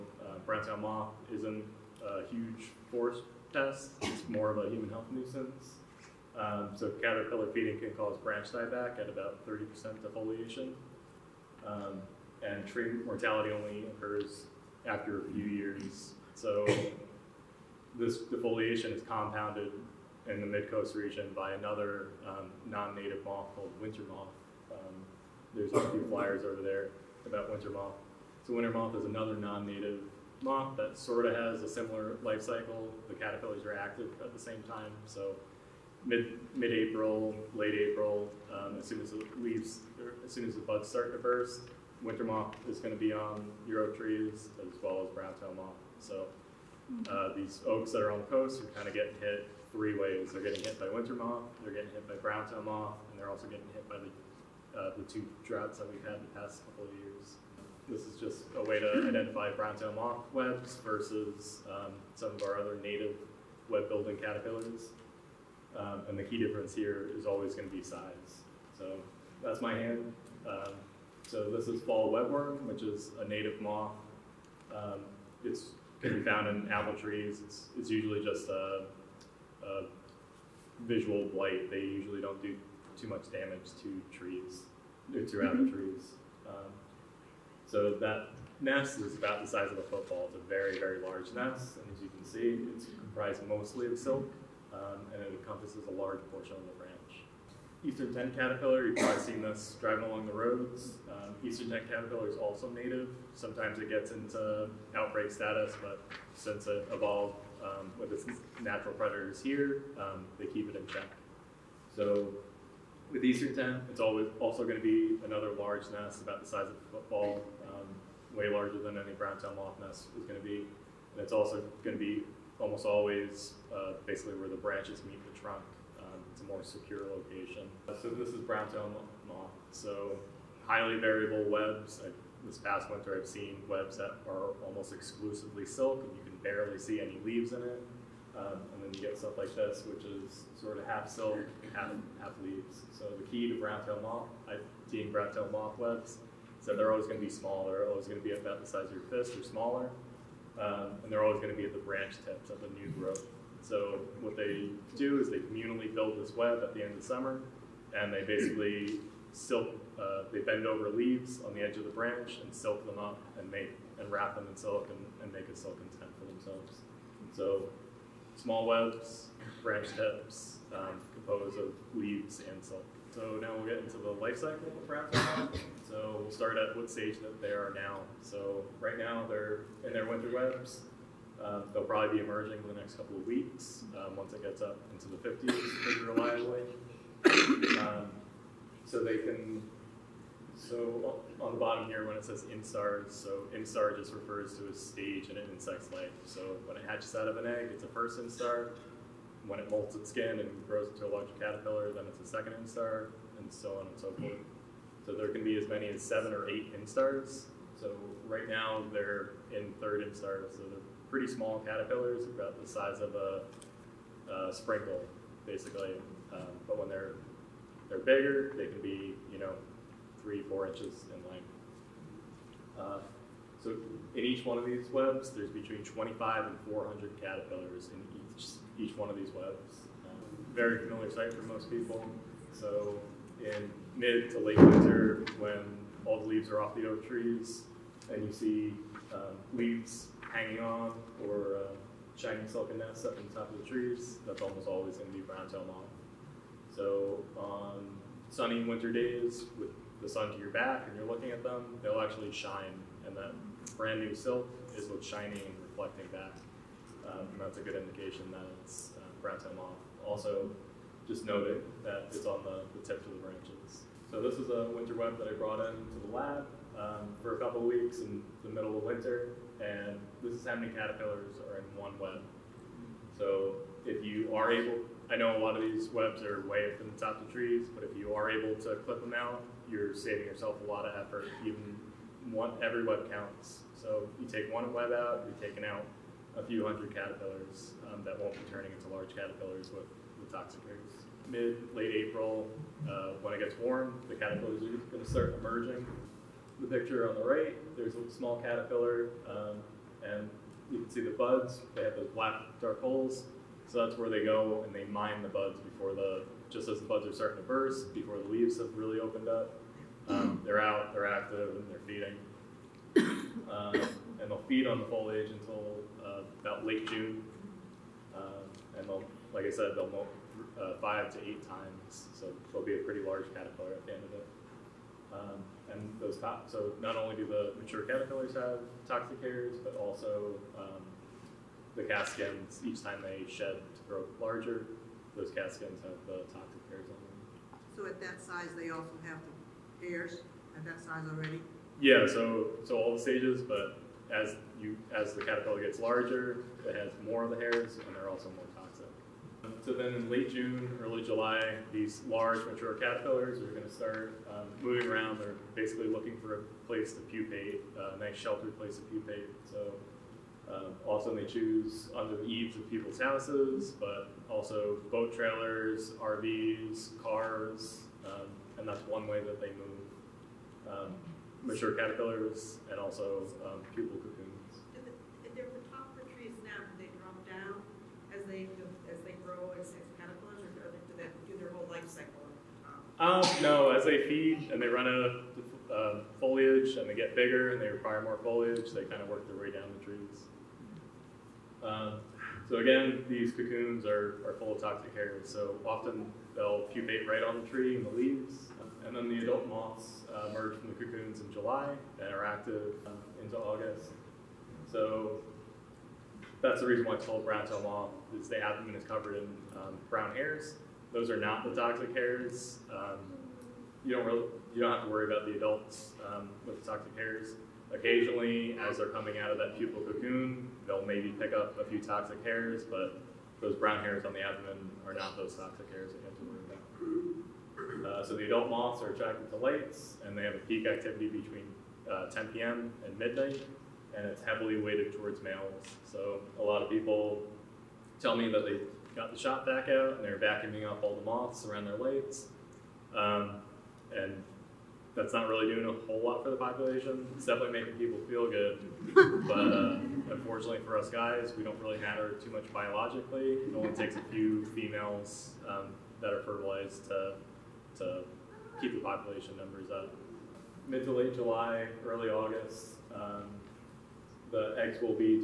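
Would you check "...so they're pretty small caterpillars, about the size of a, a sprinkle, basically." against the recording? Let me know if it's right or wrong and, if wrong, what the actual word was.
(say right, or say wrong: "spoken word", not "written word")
right.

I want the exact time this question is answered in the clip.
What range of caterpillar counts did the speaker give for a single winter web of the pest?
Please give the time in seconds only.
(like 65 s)
225 s.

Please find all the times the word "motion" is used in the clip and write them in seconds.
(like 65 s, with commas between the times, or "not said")
not said.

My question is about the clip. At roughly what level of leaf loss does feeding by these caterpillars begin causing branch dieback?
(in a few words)
30%.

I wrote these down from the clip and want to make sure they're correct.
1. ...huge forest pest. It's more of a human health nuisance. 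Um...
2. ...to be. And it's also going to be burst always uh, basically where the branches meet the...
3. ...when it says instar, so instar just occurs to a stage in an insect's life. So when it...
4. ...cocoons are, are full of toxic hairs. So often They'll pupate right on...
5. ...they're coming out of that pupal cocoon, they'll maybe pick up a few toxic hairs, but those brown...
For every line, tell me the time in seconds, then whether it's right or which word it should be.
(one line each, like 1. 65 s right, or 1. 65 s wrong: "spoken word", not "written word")
1. 2 s right
2. 120 s wrong: "almost", not "burst"
3. 192 s wrong: "refers", not "occurs"
4. 393 s right
5. 418 s right.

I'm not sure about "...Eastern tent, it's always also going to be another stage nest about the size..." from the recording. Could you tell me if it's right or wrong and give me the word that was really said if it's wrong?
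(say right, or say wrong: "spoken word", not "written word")
wrong: "large", not "stage".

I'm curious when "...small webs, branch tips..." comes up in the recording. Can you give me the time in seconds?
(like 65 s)
168 s.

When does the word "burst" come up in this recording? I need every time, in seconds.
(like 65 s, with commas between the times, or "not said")
41 s, 307 s.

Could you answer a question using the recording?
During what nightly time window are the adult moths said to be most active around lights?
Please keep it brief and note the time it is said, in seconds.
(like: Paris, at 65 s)
10 p.m. to midnight, at 431 s.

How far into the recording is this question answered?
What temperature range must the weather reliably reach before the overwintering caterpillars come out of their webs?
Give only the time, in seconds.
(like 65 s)
185 s.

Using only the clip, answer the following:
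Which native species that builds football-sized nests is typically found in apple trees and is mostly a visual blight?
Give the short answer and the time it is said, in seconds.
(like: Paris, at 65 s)
Fall webworm, at 71 s.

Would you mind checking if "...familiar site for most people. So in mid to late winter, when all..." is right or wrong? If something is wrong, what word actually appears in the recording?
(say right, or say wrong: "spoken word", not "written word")
right.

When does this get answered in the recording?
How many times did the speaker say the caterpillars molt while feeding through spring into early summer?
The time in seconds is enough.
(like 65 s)
320 s.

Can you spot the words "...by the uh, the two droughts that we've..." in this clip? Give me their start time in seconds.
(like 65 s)
53 s.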